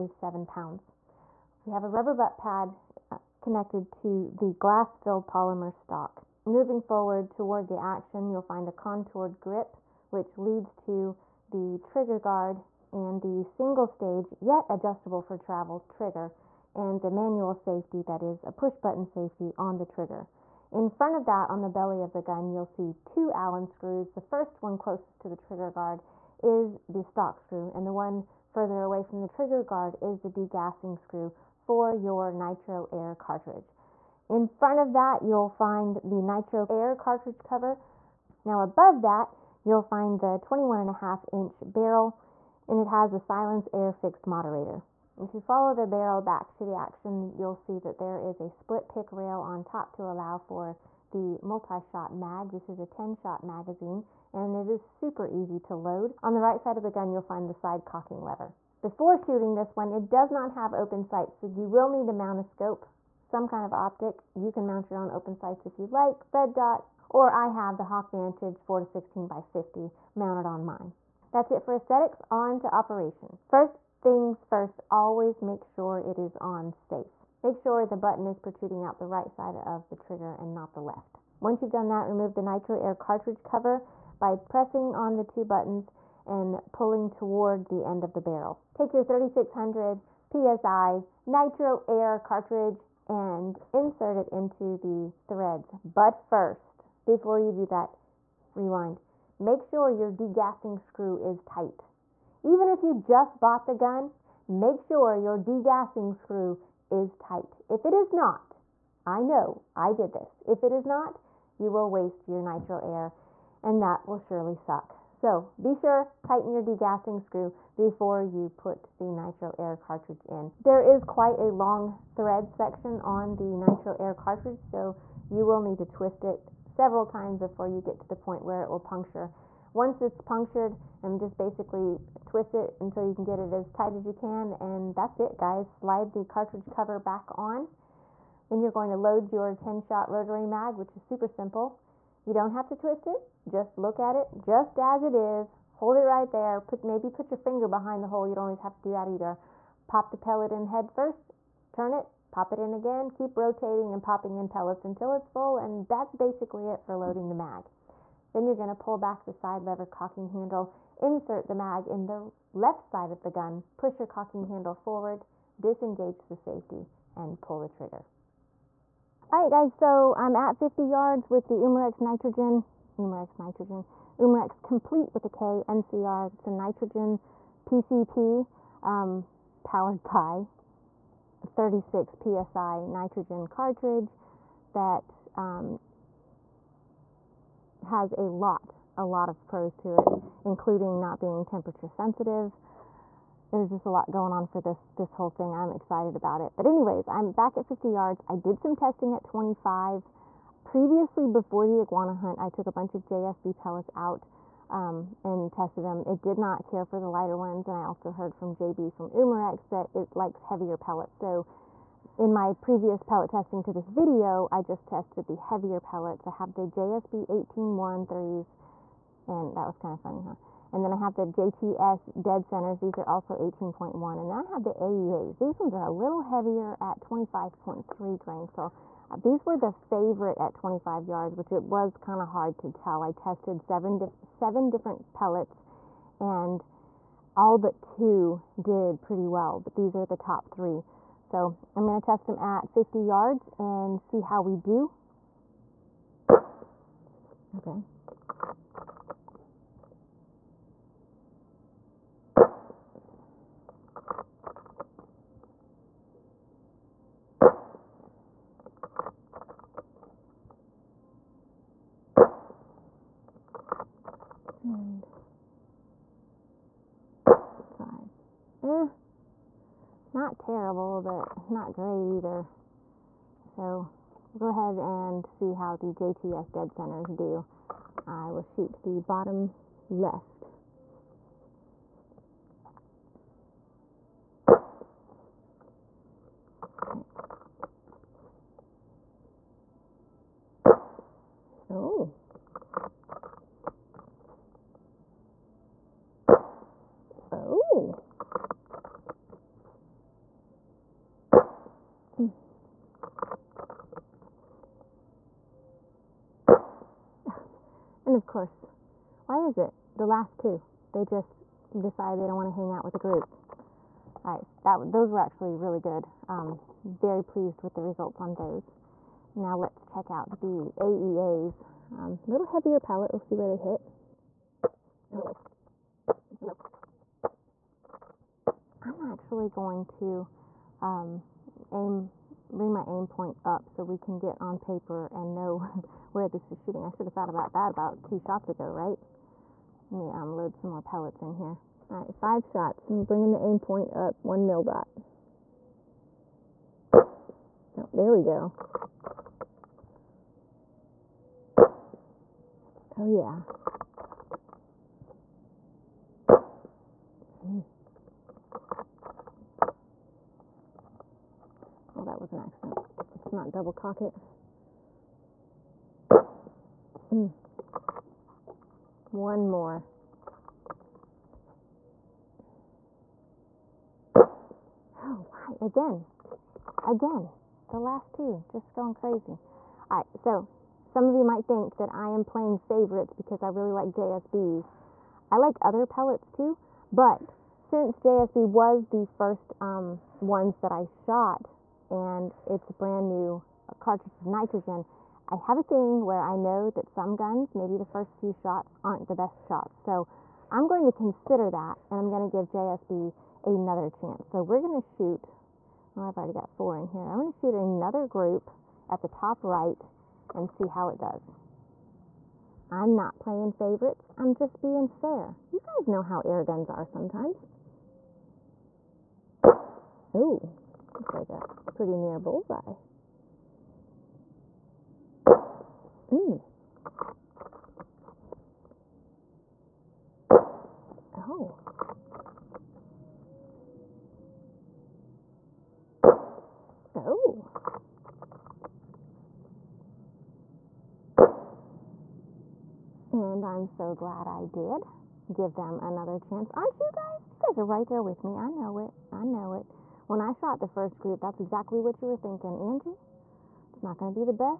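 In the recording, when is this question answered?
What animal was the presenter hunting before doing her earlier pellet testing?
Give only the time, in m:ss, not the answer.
3:21.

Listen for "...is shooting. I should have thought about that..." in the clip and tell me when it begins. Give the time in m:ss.
5:36.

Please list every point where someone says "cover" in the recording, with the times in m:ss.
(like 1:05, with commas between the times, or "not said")
0:37, 1:23, 2:16.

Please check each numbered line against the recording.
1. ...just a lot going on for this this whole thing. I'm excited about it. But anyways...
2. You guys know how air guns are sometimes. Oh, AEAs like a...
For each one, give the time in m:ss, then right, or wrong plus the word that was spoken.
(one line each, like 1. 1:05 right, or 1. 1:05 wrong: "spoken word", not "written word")
1. 3:13 right
2. 6:55 wrong: "Looks", not "AEAs".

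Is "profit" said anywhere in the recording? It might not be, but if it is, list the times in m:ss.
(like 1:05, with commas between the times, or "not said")
not said.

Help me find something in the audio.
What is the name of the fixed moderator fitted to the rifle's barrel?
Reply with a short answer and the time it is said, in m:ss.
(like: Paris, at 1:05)
SilenceAir, at 0:43.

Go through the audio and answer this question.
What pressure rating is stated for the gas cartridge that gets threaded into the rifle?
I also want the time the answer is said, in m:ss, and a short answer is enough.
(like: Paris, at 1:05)
3600 PSI, at 1:29.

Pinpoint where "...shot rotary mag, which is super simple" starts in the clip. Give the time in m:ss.
2:19.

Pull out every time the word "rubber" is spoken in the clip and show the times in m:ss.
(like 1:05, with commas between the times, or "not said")
0:01.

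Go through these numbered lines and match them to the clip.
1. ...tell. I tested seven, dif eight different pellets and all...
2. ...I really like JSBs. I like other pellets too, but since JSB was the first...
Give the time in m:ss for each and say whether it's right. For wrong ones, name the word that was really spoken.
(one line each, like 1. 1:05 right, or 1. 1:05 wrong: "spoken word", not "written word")
1. 3:52 wrong: "seven", not "eight"
2. 6:23 right.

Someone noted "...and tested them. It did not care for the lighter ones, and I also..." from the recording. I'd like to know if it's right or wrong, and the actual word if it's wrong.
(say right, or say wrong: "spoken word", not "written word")
right.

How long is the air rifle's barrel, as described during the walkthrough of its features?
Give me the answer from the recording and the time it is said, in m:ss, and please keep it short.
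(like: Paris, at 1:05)
21.5 inch, at 0:40.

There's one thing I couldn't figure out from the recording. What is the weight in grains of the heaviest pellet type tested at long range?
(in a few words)
25.3 grains.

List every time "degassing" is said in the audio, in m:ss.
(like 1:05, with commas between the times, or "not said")
0:30, 1:40, 1:45, 1:56.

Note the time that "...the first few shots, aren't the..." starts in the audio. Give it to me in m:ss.
6:37.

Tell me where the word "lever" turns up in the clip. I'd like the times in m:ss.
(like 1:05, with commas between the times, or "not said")
0:58, 2:39.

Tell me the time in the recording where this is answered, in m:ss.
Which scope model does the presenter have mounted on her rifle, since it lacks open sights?
1:07.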